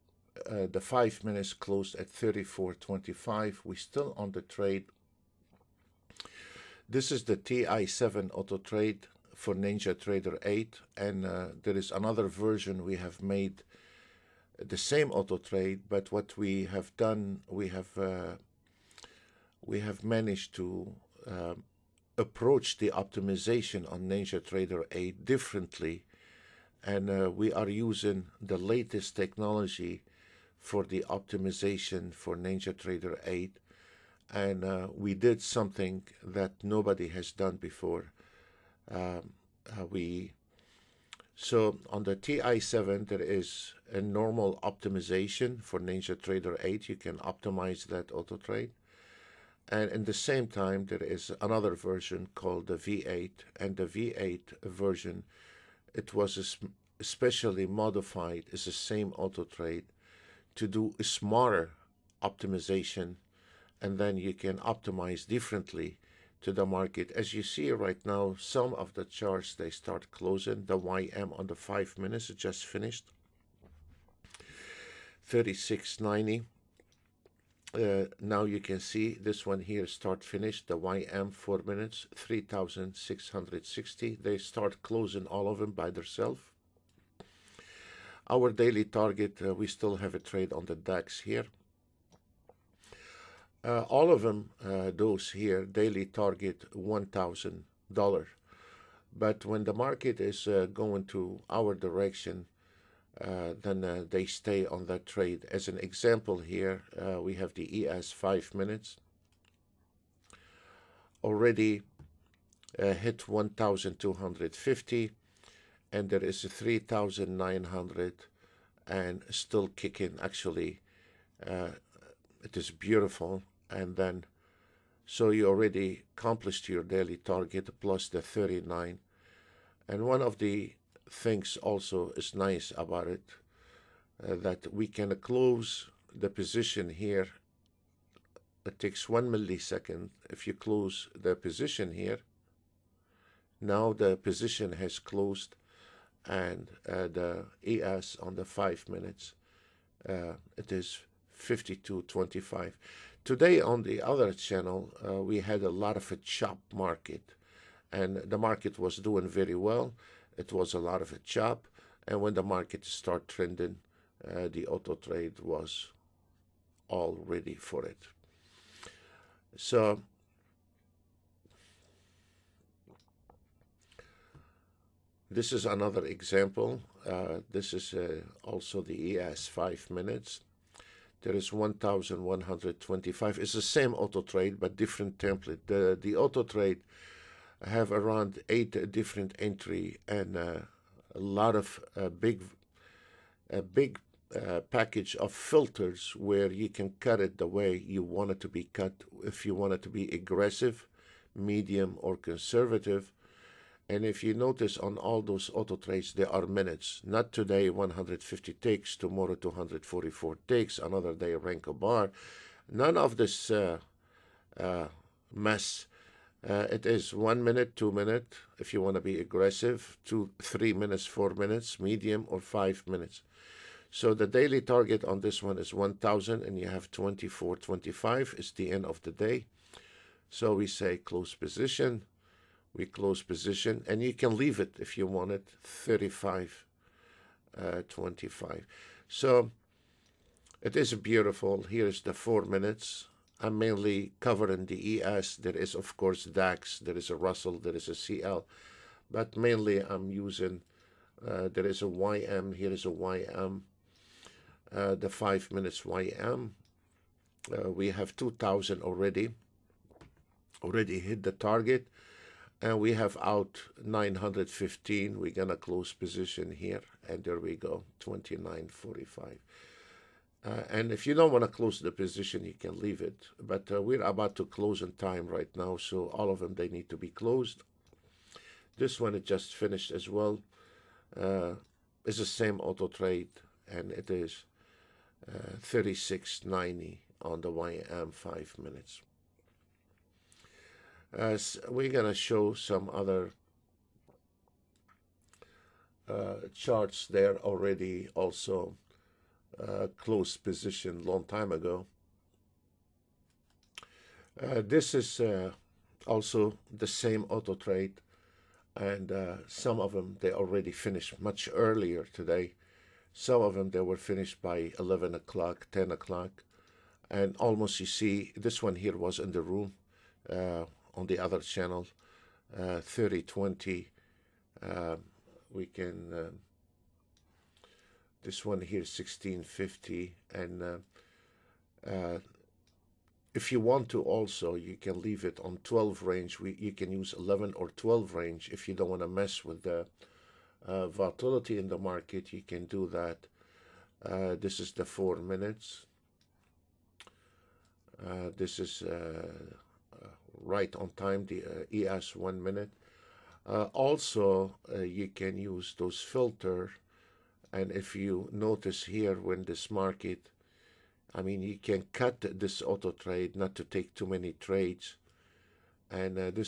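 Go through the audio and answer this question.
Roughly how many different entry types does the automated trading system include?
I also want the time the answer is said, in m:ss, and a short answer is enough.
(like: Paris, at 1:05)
eight, at 3:07.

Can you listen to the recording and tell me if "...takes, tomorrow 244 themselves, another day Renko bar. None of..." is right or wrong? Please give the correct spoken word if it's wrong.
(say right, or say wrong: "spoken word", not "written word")
wrong: "takes", not "themselves".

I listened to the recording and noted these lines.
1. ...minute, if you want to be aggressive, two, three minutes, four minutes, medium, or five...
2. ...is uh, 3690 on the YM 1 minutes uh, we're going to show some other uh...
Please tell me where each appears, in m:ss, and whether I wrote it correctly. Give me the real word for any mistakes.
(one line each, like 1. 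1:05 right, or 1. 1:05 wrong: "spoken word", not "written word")
1. 3:37 right
2. 4:44 wrong: "5", not "1".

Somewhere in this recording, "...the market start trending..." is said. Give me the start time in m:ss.
2:42.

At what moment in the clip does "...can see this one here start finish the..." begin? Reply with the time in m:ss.
1:18.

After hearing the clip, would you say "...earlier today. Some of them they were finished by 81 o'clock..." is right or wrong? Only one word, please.
wrong.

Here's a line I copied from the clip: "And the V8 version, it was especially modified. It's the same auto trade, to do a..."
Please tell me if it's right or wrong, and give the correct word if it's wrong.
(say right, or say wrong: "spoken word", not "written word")
right.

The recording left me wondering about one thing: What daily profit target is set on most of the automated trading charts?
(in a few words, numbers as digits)
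$1,000.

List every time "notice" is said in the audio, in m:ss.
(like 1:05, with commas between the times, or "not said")
3:24, 5:58.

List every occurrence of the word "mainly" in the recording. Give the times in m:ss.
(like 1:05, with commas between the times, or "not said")
4:03, 4:09.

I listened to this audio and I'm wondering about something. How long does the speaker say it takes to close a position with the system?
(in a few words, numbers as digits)
one millisecond.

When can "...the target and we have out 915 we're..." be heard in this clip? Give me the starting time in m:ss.
4:21.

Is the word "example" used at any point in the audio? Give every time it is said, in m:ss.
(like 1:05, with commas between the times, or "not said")
1:45, 2:56.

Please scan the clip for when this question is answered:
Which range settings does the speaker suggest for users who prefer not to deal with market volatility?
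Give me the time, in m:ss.
5:37.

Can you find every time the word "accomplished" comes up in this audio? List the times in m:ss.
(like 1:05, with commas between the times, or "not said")
2:06.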